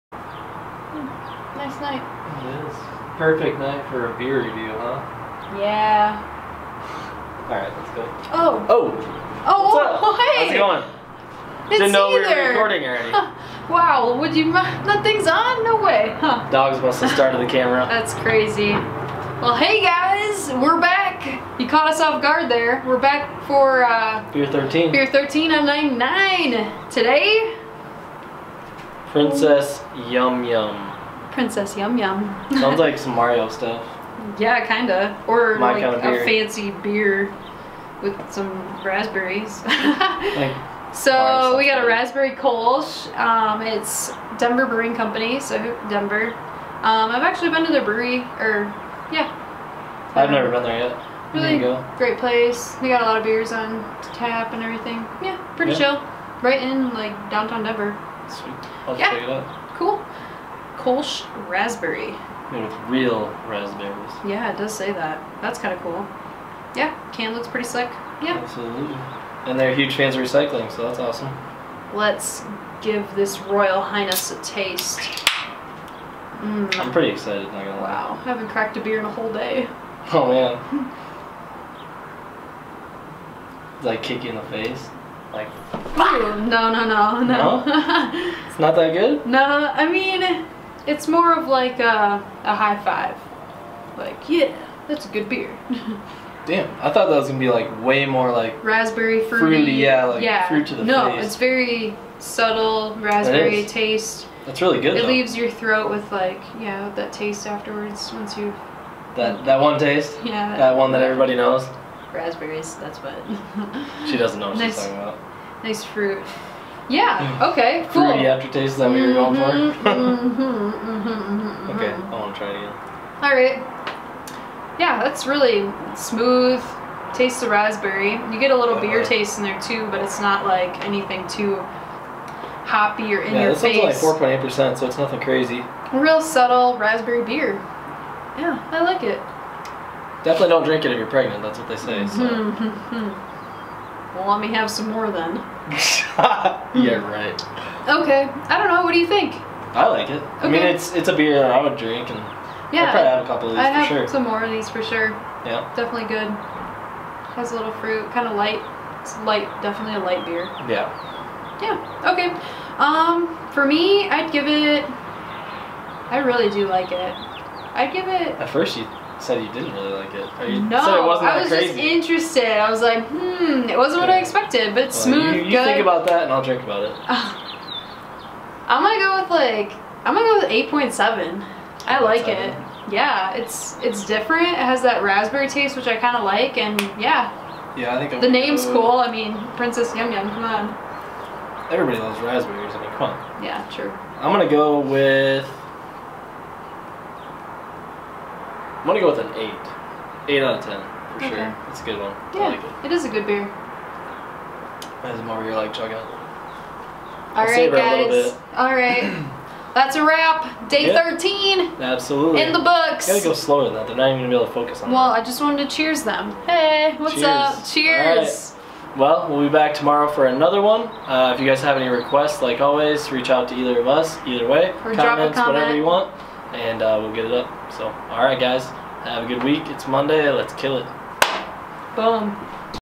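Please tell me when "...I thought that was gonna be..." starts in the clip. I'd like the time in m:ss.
1:36.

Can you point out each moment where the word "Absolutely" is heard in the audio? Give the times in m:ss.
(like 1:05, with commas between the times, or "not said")
1:08, 3:31.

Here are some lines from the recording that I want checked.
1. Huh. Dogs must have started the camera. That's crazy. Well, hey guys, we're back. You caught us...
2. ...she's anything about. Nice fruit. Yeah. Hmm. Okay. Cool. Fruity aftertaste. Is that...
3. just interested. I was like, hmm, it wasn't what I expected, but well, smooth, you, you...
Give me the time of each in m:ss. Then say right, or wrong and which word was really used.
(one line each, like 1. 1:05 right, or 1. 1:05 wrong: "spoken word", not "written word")
1. 0:16 right
2. 1:54 wrong: "talking", not "anything"
3. 2:51 right.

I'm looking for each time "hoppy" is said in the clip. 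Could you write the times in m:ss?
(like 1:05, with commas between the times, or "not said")
2:12.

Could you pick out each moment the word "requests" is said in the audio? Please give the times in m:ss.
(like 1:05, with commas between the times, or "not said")
3:41.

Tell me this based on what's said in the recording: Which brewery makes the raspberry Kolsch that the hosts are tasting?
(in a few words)
Denver Brewing Company.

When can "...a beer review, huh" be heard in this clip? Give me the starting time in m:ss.
0:04.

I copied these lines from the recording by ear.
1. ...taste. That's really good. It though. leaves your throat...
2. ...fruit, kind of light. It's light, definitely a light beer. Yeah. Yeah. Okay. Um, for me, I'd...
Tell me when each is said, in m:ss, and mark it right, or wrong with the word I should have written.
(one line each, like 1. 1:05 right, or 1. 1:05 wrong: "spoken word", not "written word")
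1. 1:43 right
2. 2:37 right.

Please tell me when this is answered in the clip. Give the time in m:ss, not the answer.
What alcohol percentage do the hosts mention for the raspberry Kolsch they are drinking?
2:14.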